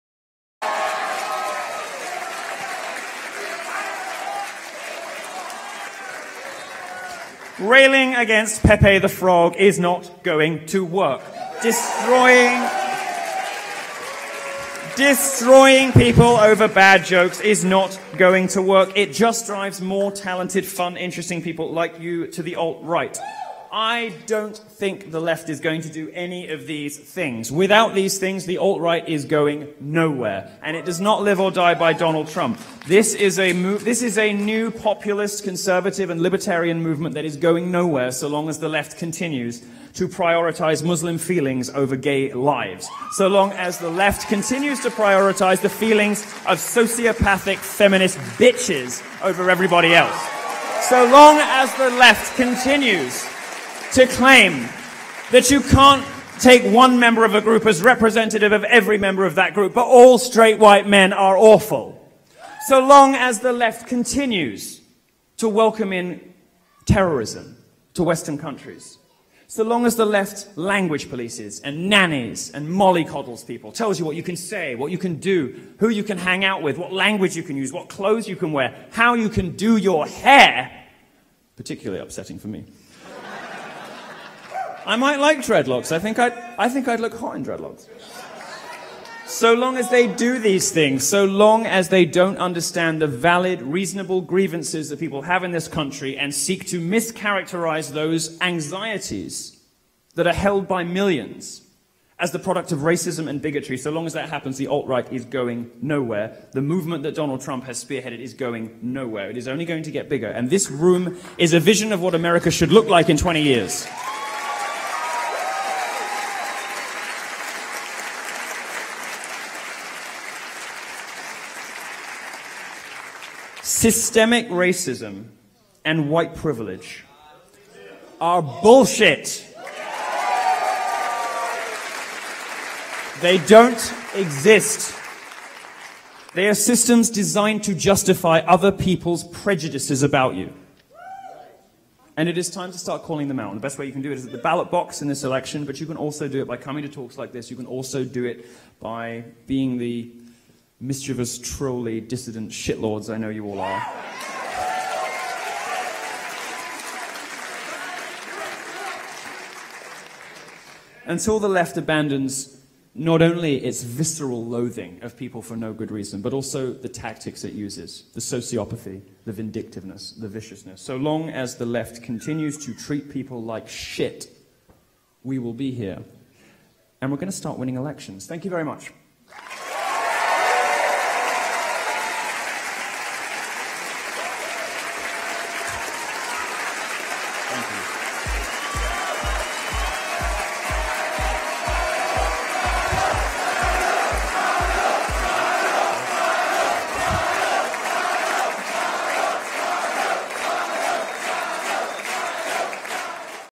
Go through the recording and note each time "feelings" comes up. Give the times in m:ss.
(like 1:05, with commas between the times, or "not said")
0:41, 0:45.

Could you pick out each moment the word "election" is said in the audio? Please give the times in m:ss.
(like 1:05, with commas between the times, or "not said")
2:25, 2:57.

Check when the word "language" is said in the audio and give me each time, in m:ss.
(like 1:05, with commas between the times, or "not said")
1:10, 1:16.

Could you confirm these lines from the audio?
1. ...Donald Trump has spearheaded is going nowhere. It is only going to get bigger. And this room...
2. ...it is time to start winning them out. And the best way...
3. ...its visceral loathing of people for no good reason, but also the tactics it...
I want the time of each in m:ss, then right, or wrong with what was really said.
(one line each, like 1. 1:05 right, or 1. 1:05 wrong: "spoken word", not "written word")
1. 1:47 right
2. 2:22 wrong: "calling", not "winning"
3. 2:43 right.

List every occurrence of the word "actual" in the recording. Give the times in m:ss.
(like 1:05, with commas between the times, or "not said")
not said.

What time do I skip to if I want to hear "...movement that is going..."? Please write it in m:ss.
0:36.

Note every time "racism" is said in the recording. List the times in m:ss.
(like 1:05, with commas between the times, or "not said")
1:42, 2:04.